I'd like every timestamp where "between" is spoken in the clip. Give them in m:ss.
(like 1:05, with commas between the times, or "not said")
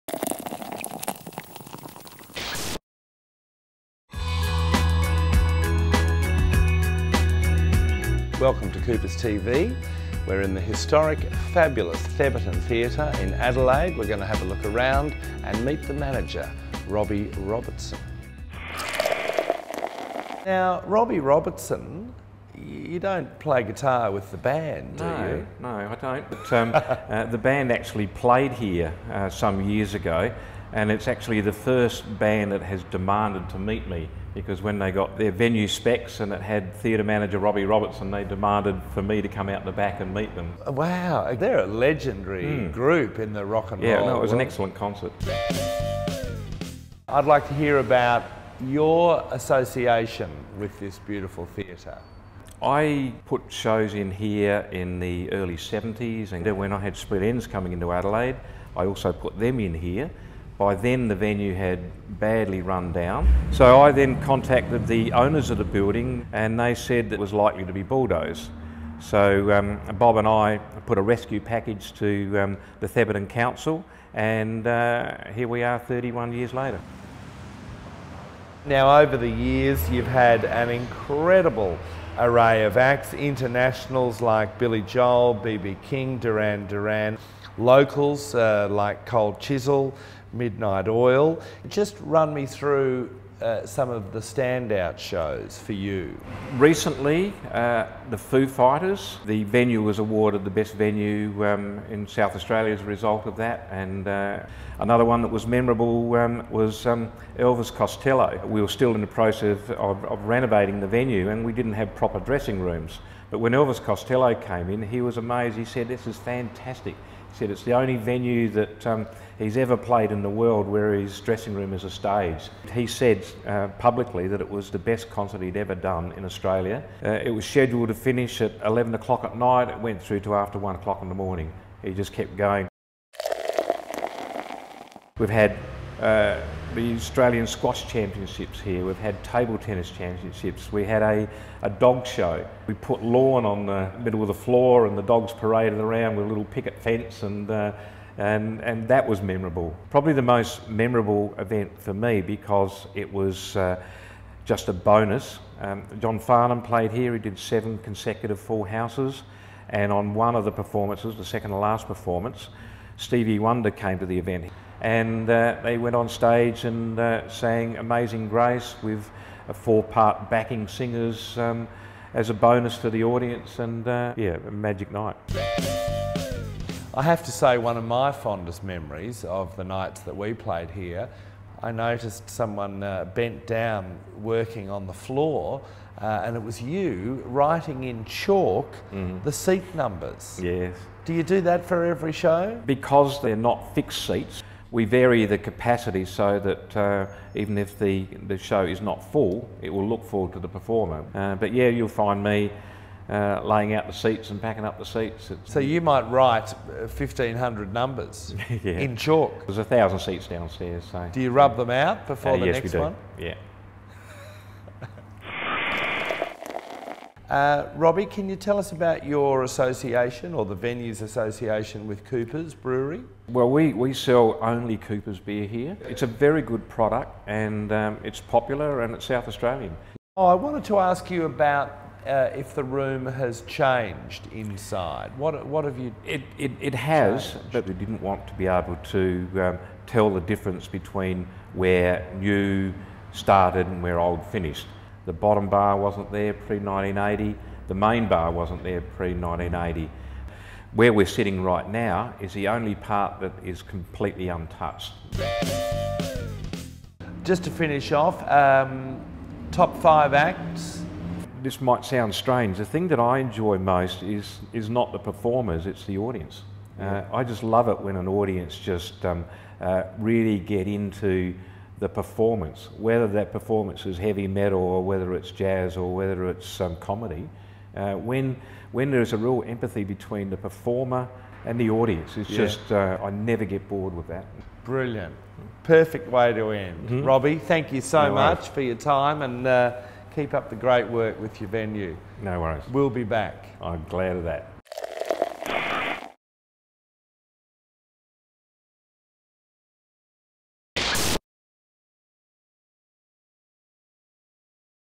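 4:00, 4:39.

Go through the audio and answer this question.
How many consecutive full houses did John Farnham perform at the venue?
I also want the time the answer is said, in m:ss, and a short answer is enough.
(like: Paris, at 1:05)
7, at 2:37.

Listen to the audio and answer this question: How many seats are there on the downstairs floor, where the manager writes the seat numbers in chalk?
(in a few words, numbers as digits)
1,000.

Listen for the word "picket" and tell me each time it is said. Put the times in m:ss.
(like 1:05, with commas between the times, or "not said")
2:26.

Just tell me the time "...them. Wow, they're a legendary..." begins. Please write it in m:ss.
0:40.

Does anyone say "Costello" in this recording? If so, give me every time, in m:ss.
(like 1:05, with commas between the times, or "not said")
1:47, 1:53.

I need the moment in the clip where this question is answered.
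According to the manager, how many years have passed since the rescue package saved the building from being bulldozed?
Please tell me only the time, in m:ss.
1:15.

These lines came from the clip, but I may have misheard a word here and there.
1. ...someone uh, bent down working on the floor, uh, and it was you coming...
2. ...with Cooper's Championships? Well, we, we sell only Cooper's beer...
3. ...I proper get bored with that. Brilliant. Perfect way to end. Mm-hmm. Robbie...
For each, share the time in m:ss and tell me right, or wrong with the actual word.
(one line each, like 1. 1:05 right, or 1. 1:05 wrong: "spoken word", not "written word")
1. 3:02 wrong: "writing", not "coming"
2. 3:41 wrong: "Brewery", not "Championships"
3. 4:43 wrong: "never", not "proper".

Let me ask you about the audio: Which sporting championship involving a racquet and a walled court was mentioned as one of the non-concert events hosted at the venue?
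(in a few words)
Australian Squash Championships.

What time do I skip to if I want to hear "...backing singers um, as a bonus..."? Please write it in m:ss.
2:50.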